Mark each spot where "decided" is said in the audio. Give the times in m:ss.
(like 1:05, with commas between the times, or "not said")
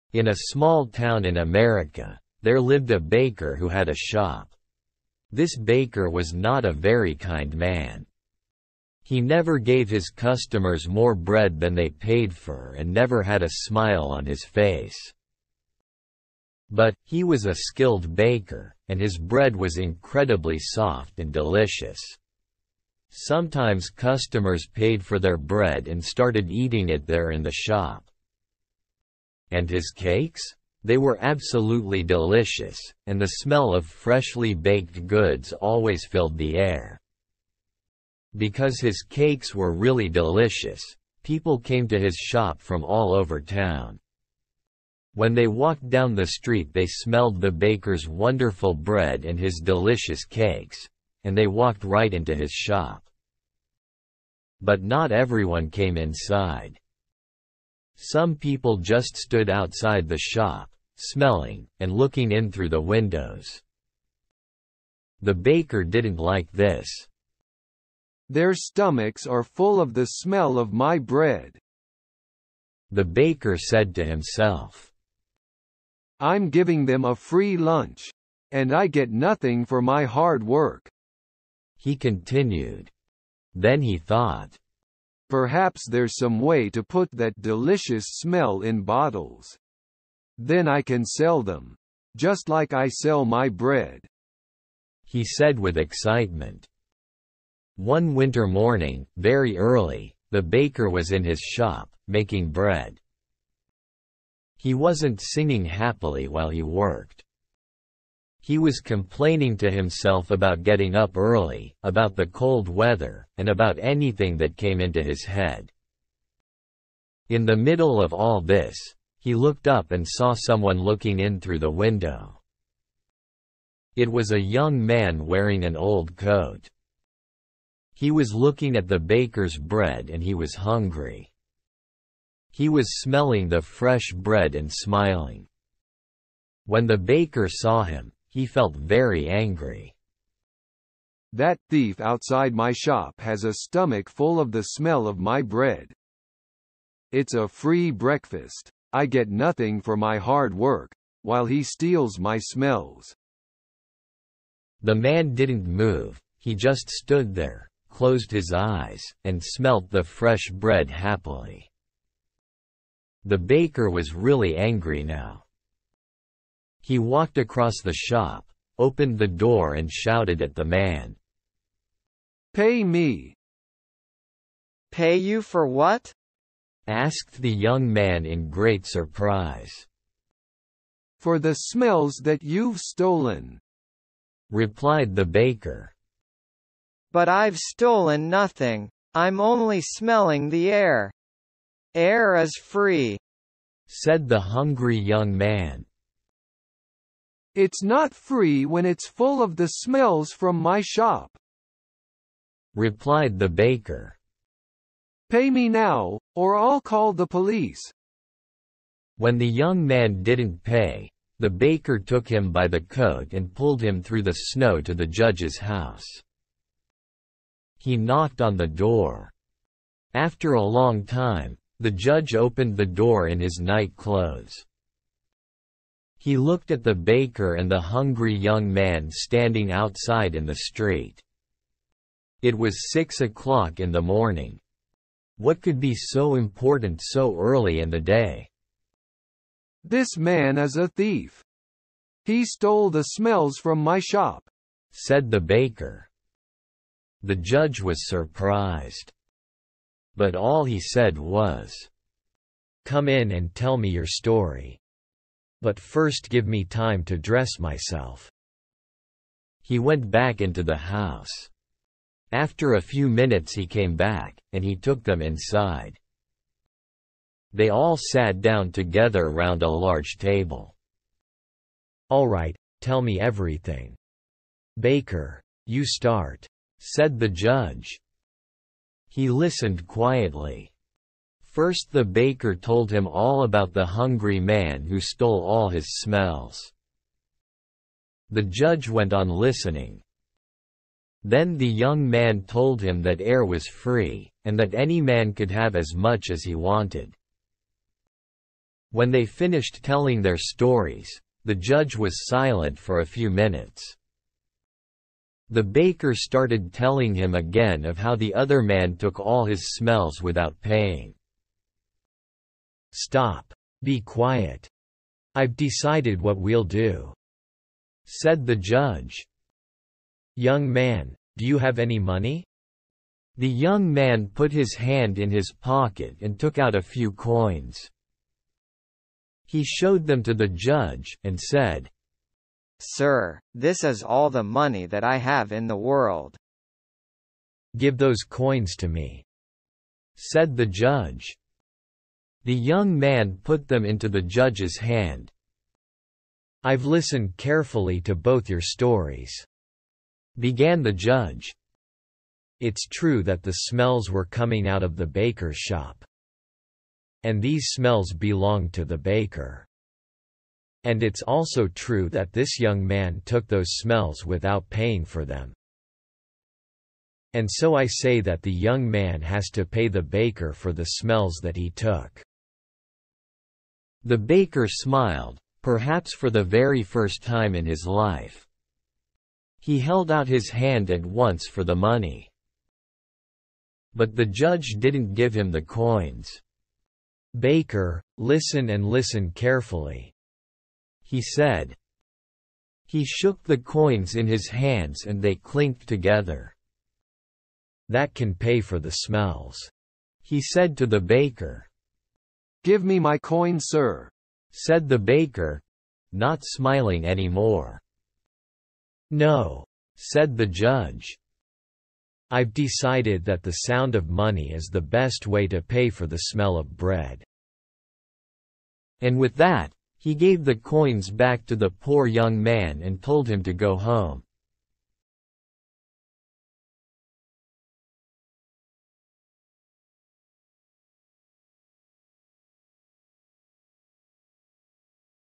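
5:15, 6:52.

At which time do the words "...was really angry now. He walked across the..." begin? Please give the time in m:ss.
2:43.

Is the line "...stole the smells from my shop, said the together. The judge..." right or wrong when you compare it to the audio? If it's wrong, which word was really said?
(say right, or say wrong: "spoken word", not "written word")
wrong: "baker", not "together".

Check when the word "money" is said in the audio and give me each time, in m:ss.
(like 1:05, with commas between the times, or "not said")
5:21, 5:34, 6:21, 6:54.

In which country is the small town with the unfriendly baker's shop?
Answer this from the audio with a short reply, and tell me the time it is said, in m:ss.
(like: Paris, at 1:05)
America, at 0:01.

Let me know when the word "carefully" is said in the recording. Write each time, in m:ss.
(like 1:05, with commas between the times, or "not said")
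5:47, 6:29.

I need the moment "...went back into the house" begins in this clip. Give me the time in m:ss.
4:19.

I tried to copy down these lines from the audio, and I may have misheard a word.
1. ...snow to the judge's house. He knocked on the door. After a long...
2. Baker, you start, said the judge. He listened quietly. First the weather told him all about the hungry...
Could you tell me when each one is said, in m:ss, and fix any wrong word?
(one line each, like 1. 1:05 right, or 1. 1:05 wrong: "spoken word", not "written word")
1. 3:34 right
2. 4:34 wrong: "baker", not "weather".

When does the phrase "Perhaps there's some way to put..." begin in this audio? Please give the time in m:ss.
1:25.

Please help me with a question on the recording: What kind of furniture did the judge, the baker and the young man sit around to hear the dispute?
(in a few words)
A large table.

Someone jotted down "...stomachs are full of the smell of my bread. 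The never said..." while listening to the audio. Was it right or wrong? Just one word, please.
wrong.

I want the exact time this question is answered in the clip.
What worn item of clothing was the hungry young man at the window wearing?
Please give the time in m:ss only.
2:05.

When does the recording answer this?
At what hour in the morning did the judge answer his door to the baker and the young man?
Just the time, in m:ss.
3:52.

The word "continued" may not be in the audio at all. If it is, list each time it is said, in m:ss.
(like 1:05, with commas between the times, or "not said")
1:21.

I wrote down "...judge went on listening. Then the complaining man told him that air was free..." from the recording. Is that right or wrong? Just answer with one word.
wrong.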